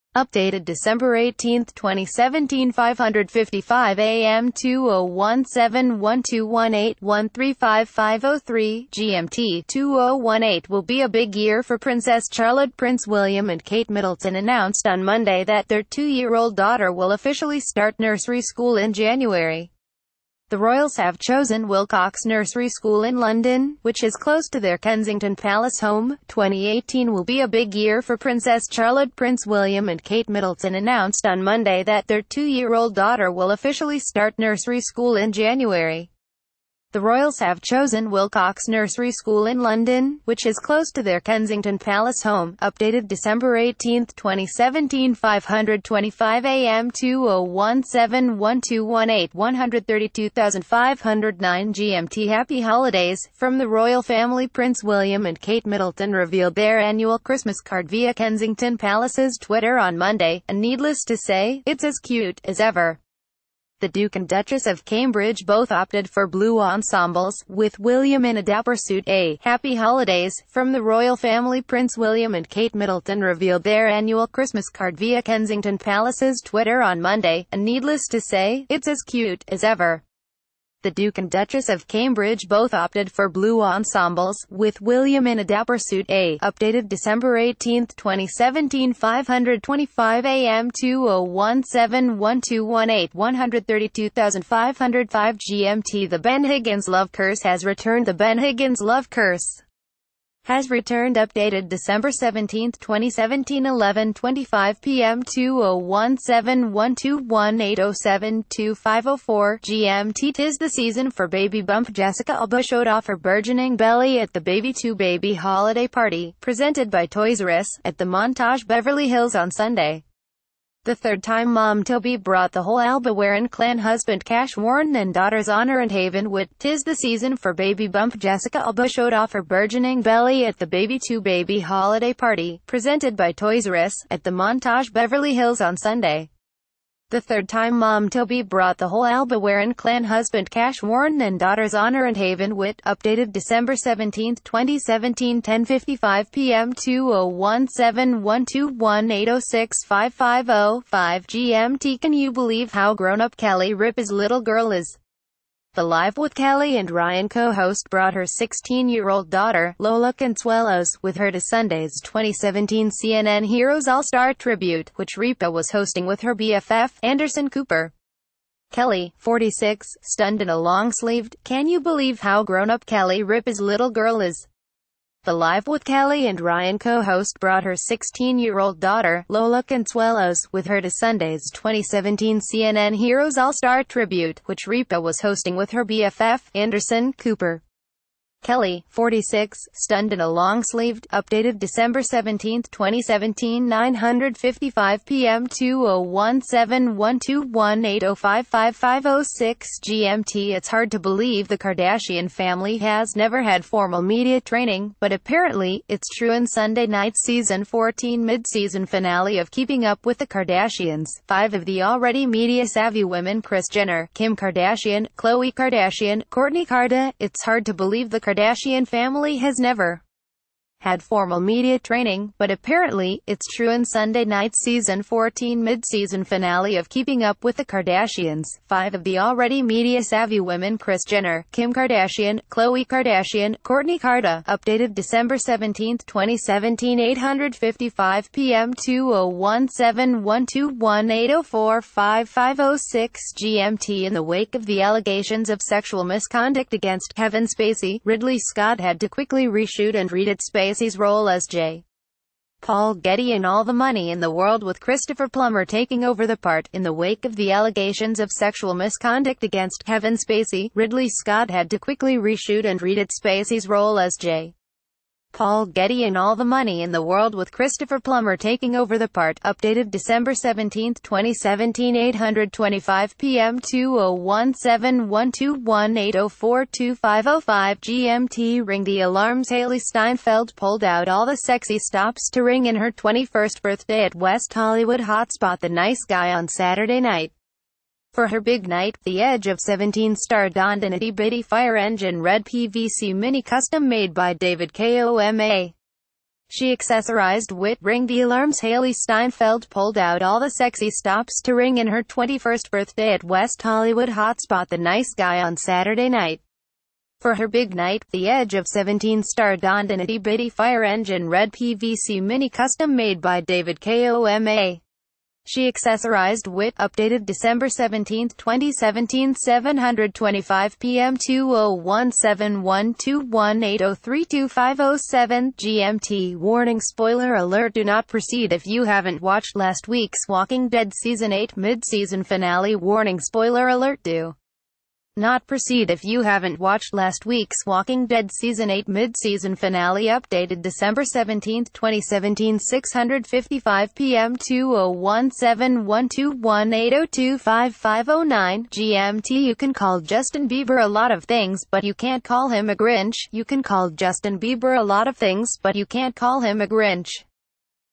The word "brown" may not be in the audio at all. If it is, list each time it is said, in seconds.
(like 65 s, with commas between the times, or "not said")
not said.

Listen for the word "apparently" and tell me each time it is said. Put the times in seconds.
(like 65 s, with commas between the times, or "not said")
205 s, 222 s.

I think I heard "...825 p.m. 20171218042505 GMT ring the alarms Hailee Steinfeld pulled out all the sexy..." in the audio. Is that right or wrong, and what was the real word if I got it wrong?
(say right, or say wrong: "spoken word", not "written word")
right.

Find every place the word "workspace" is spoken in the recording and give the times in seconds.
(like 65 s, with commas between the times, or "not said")
not said.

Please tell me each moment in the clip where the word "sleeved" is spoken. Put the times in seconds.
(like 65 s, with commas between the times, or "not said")
170 s, 190 s.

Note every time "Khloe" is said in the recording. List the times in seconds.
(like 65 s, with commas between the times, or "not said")
215 s, 232 s.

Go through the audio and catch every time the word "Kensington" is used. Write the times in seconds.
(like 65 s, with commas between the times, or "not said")
24 s, 41 s, 58 s, 75 s.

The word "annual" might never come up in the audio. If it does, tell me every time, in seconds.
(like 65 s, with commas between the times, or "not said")
56 s, 73 s.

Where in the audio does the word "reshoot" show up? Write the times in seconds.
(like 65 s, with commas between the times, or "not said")
249 s, 262 s.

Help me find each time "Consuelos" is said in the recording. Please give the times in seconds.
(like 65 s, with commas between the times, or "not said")
160 s, 179 s.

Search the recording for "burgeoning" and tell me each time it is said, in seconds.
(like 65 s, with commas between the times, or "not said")
113 s, 129 s.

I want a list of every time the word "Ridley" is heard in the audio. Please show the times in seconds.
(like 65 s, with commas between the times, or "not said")
248 s, 260 s.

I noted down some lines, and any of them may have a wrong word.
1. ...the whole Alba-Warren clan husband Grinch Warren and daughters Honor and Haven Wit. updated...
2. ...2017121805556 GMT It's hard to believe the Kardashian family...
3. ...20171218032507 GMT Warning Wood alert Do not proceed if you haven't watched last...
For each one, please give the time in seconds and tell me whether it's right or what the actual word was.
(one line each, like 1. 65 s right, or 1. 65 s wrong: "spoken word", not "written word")
1. 138 s wrong: "Cash", not "Grinch"
2. 195 s right
3. 321 s wrong: "Spoiler", not "Wood".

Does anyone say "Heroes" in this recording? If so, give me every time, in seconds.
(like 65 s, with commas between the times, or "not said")
163 s, 182 s.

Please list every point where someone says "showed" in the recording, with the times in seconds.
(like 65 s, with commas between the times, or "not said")
112 s, 128 s.